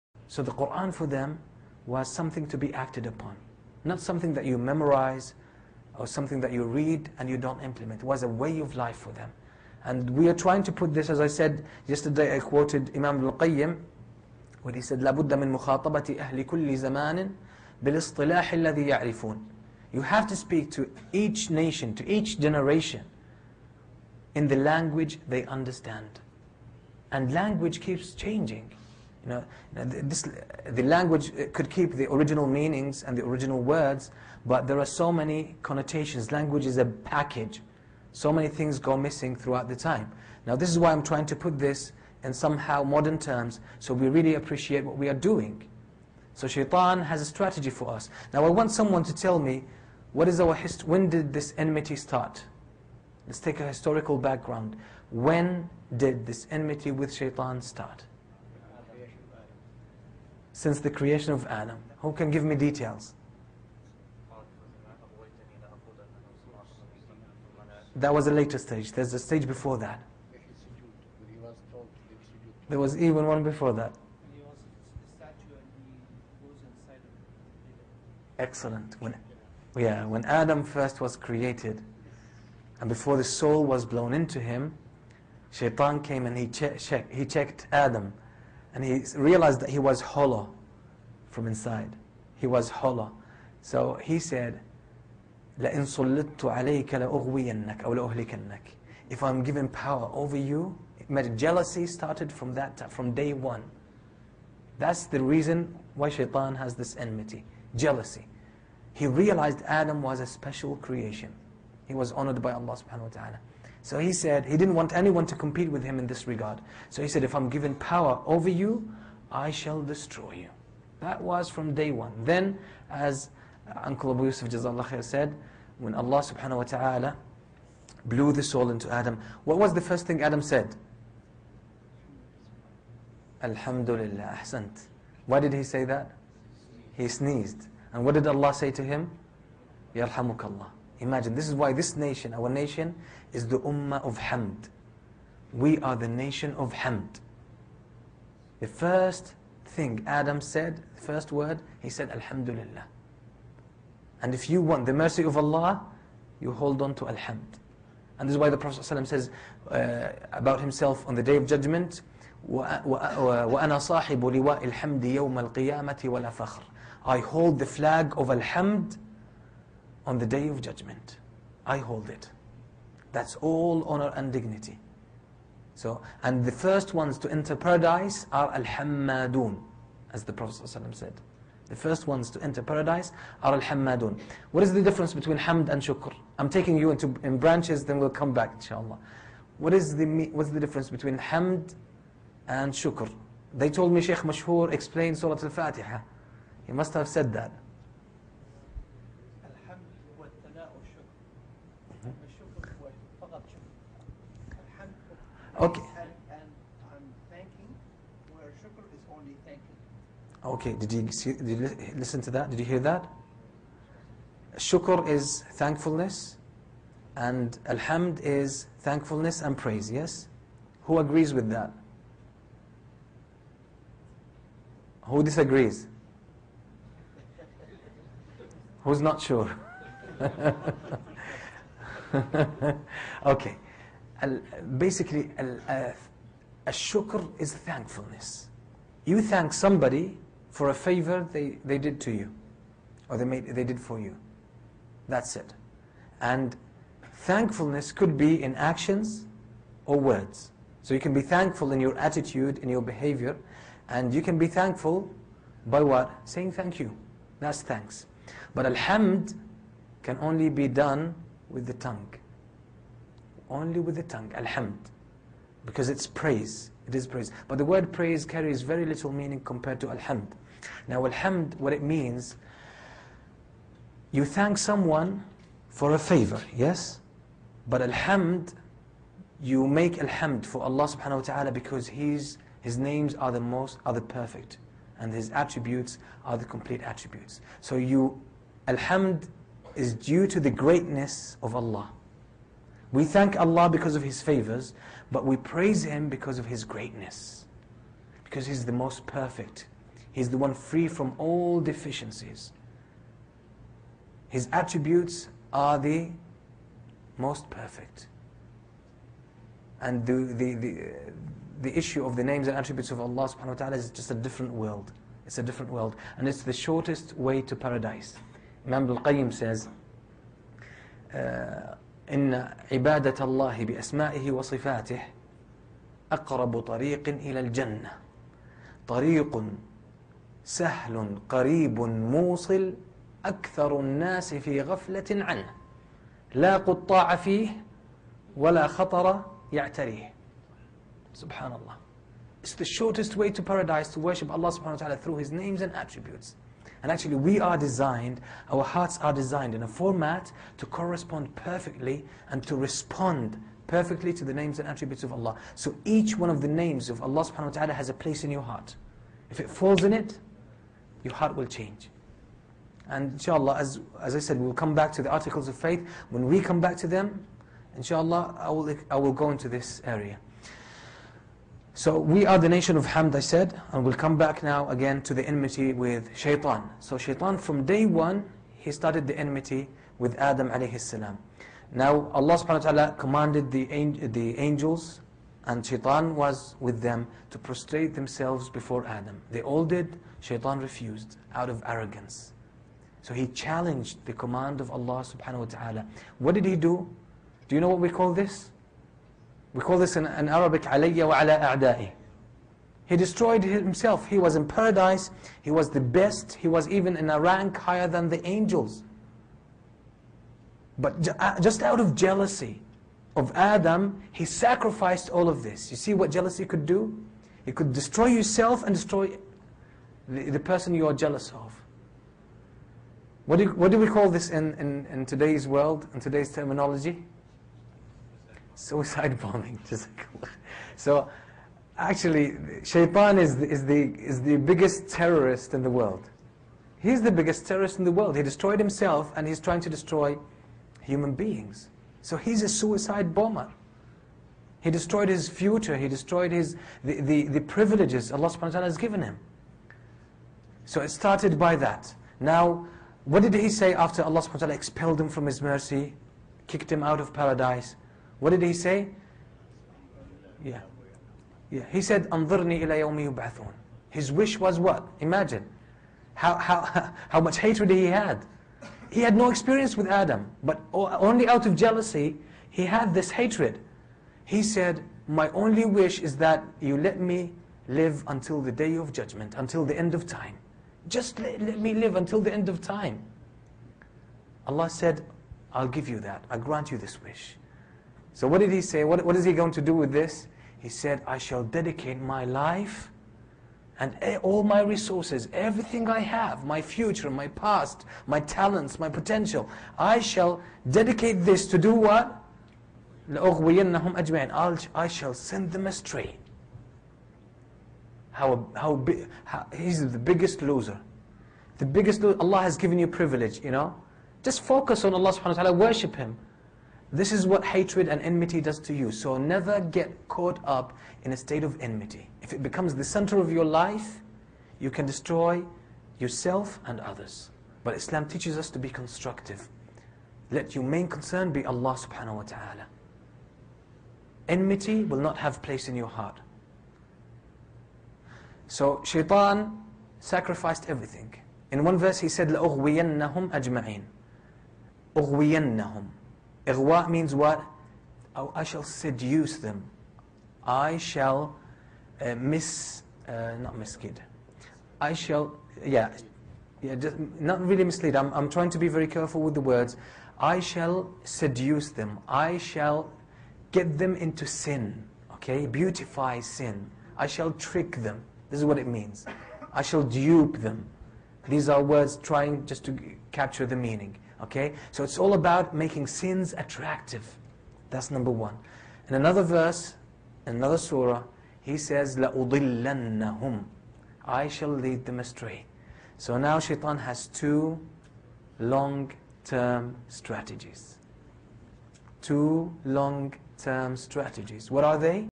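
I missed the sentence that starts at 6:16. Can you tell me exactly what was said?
So Shaitan from day one, he started the enmity with Adam alayhi salam.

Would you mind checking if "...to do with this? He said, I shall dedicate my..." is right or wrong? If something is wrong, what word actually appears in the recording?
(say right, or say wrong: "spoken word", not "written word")
right.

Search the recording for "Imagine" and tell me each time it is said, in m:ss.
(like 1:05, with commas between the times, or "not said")
2:21, 7:44.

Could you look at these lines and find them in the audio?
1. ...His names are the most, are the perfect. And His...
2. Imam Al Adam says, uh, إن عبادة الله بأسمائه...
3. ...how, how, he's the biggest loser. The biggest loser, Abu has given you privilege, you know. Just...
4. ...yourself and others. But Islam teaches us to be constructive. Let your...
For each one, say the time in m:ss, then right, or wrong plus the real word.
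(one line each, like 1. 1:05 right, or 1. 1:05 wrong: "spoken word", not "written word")
1. 4:42 right
2. 5:18 wrong: "Qayyim", not "Adam"
3. 8:28 wrong: "Allah", not "Abu"
4. 8:45 right.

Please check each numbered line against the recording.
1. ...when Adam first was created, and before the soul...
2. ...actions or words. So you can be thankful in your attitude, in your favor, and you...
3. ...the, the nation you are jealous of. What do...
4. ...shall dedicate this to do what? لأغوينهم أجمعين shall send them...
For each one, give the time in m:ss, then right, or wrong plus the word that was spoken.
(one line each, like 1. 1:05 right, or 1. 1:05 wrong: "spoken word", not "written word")
1. 1:20 right
2. 4:08 wrong: "behavior", not "favor"
3. 7:00 wrong: "person", not "nation"
4. 8:19 right.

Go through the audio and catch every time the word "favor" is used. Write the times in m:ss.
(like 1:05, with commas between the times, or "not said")
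4:00, 4:35, 4:54.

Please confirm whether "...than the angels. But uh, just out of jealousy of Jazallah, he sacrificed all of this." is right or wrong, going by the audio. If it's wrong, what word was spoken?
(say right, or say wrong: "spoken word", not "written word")
wrong: "Adam", not "Jazallah".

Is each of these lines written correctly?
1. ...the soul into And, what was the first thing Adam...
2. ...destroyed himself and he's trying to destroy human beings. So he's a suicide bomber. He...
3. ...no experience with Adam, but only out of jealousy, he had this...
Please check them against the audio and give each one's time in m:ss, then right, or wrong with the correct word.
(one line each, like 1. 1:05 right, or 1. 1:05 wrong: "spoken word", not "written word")
1. 2:08 wrong: "Adam", not "And"
2. 7:18 right
3. 7:49 right.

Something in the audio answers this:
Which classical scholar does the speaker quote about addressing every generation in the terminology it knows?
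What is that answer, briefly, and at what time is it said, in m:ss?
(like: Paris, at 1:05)
Imam Al-Qayyim, at 0:12.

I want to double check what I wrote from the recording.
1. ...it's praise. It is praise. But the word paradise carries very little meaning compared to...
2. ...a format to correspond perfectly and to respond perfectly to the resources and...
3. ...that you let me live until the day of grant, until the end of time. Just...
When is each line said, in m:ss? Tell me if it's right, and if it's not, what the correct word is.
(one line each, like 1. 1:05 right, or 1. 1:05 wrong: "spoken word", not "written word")
1. 4:25 wrong: "praise", not "paradise"
2. 5:49 wrong: "names", not "resources"
3. 7:56 wrong: "judgment", not "grant".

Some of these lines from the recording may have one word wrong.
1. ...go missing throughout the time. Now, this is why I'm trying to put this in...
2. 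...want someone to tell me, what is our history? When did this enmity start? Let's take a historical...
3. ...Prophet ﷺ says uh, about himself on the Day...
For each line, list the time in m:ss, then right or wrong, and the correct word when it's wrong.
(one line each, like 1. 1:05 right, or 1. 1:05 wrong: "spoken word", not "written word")
1. 0:38 right
2. 0:48 right
3. 2:38 right.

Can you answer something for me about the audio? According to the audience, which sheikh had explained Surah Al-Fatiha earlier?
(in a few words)
Sheikh Mashhur.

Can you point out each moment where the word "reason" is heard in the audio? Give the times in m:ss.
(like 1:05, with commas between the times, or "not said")
1:45.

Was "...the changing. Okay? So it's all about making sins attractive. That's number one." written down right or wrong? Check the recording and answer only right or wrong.
wrong.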